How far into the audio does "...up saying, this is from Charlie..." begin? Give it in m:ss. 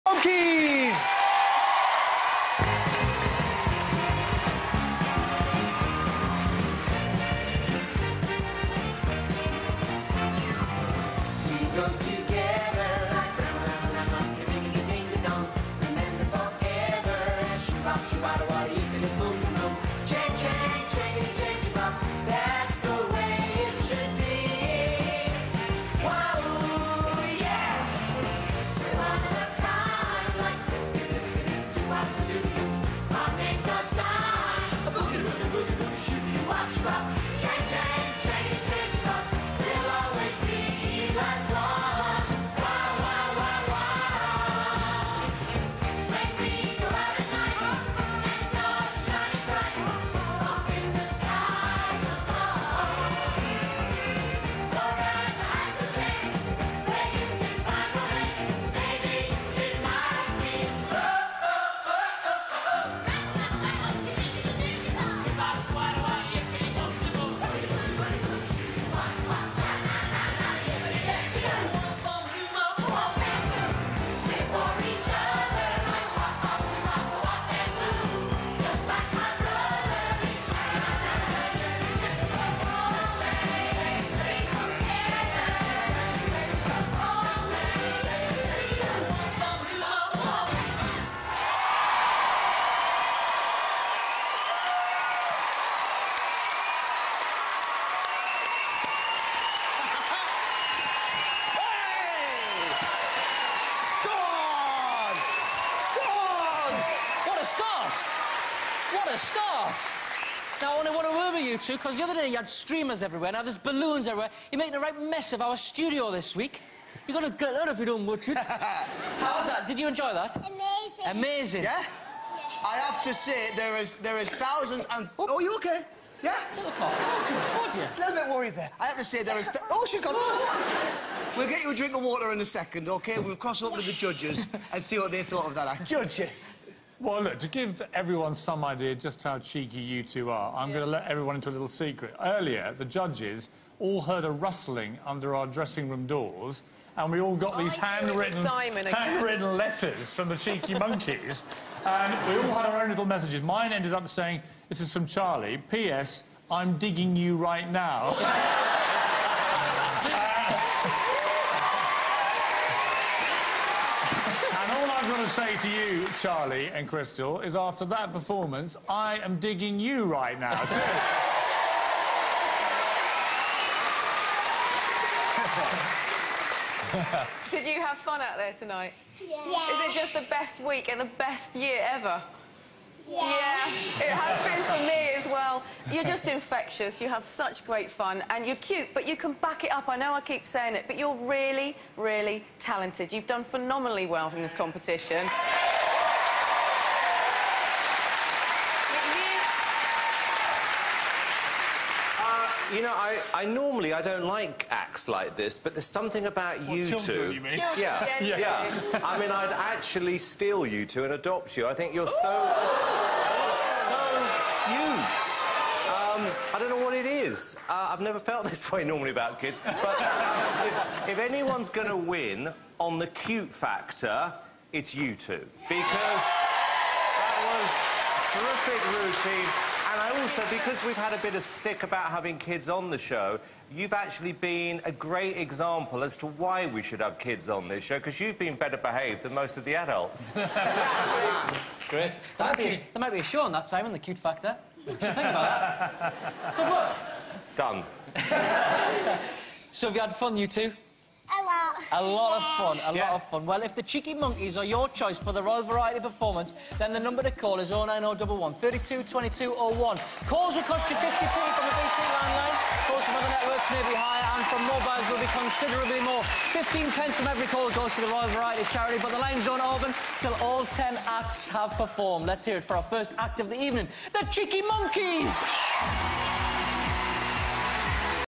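2:33.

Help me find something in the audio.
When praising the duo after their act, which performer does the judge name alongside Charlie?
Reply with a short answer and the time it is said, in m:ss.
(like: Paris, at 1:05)
Crystal, at 2:46.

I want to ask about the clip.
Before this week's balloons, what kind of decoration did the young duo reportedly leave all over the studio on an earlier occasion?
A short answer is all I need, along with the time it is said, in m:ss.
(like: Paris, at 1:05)
Streamers, at 1:52.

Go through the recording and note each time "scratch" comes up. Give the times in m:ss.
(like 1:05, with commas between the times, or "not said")
not said.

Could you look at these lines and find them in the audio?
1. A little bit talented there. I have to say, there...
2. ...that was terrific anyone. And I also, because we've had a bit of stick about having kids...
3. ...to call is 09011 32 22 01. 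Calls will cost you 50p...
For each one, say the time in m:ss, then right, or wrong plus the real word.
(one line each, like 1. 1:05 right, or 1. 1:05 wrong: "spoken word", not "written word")
1. 2:07 wrong: "worried", not "talented"
2. 3:47 wrong: "routine", not "anyone"
3. 4:17 right.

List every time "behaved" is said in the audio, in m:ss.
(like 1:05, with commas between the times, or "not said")
3:58.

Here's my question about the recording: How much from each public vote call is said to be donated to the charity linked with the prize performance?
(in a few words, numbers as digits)
15p.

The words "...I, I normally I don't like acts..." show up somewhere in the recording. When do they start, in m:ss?
3:22.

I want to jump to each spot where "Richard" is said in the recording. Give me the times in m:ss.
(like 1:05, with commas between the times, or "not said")
1:58.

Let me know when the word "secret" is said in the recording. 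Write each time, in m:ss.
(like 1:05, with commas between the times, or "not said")
2:21.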